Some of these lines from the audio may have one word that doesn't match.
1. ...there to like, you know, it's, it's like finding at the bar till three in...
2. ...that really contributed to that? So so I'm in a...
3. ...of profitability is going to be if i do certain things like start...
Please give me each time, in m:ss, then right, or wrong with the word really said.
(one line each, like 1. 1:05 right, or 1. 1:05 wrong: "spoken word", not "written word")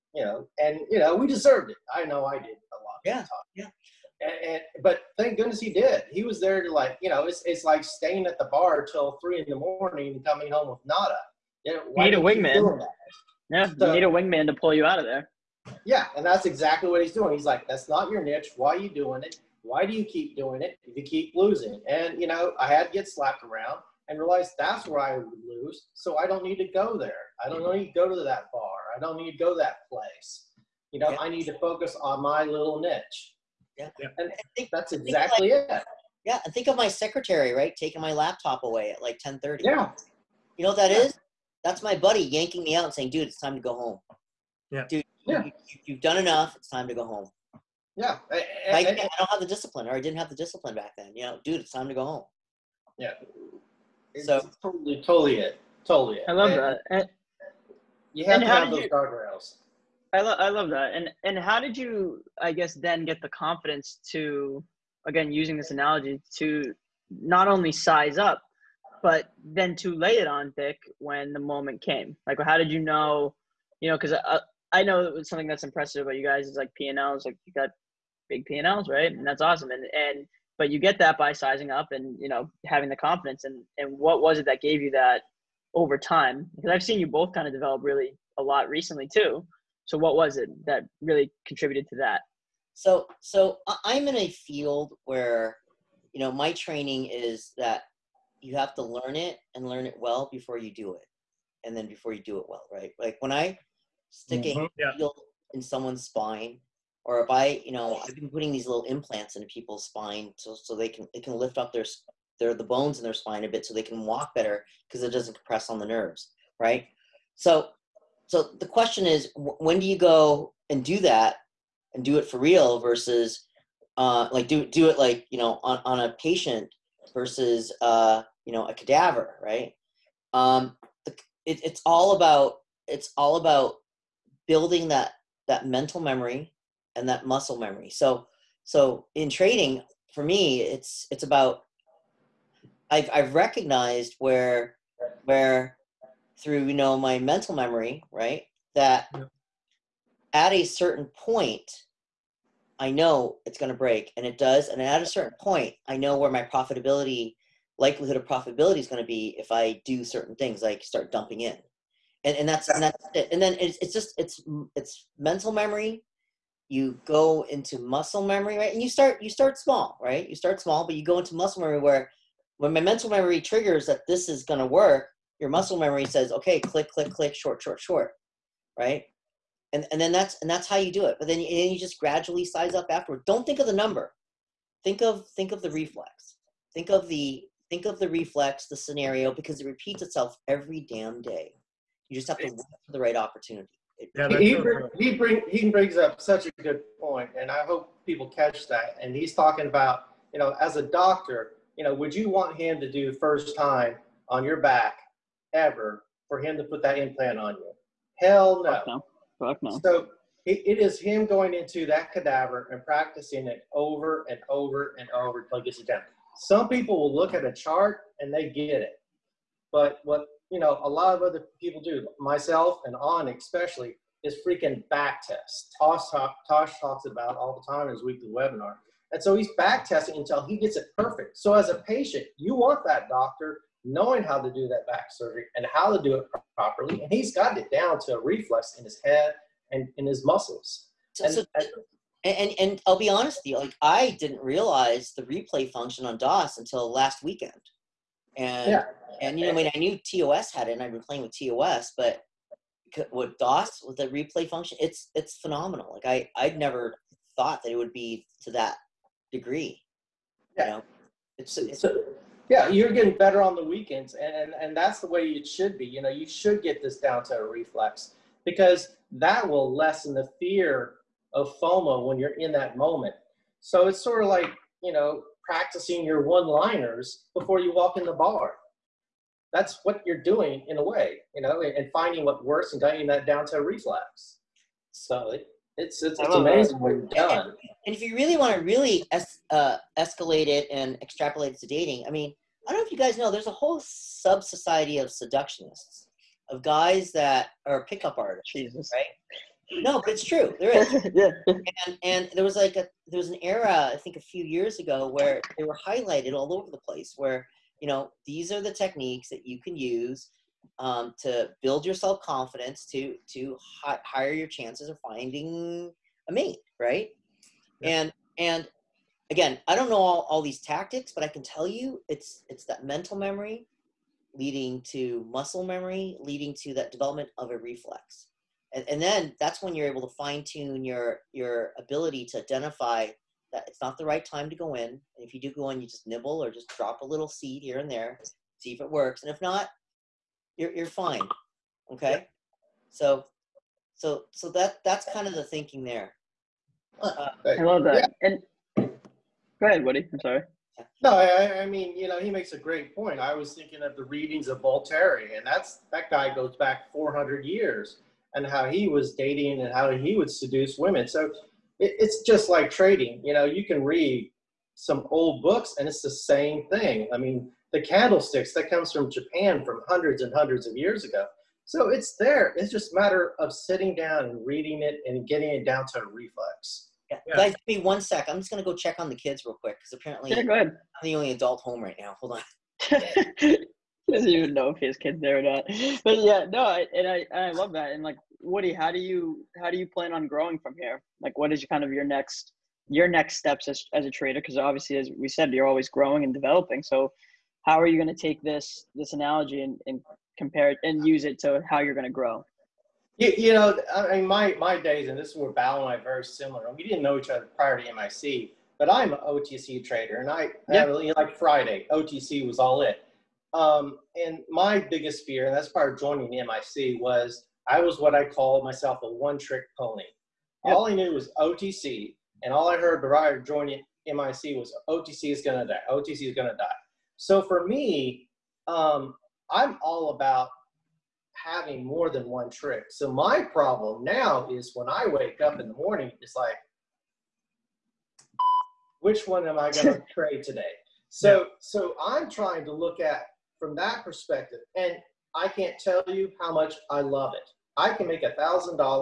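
1. 0:06 wrong: "staying", not "finding"
2. 1:30 right
3. 2:38 right.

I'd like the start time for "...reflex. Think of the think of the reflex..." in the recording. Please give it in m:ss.
3:05.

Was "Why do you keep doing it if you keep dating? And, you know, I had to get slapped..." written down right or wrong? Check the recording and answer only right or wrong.
wrong.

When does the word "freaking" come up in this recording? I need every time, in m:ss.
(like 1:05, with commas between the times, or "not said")
3:44.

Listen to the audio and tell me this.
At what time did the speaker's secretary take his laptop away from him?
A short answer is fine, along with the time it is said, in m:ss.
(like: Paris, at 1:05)
10:30, at 0:39.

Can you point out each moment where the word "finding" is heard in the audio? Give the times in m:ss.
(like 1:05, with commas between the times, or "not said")
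4:41, 5:14.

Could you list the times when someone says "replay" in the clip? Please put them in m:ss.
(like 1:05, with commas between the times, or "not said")
4:05, 4:14.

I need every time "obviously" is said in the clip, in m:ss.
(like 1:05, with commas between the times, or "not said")
6:34.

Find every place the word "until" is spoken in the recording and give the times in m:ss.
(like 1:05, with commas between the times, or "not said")
3:35, 3:50, 4:06.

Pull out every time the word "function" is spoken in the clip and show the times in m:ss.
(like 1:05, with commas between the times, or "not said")
4:05, 4:14.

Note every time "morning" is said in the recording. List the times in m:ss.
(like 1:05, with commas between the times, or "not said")
0:09, 7:15.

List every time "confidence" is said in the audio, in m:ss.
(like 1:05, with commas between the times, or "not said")
1:03, 1:22, 5:12.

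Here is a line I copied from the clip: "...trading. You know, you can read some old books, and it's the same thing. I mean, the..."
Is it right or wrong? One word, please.
right.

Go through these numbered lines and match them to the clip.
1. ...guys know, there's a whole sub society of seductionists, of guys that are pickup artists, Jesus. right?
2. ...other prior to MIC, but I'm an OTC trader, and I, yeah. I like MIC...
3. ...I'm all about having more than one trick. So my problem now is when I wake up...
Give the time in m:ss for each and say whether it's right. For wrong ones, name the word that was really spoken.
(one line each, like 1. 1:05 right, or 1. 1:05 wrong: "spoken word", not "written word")
1. 4:52 right
2. 6:47 wrong: "Friday", not "MIC"
3. 7:09 right.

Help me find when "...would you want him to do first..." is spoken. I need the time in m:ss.
3:21.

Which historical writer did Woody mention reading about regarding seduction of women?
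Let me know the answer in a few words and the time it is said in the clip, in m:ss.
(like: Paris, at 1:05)
Voltaire, at 5:54.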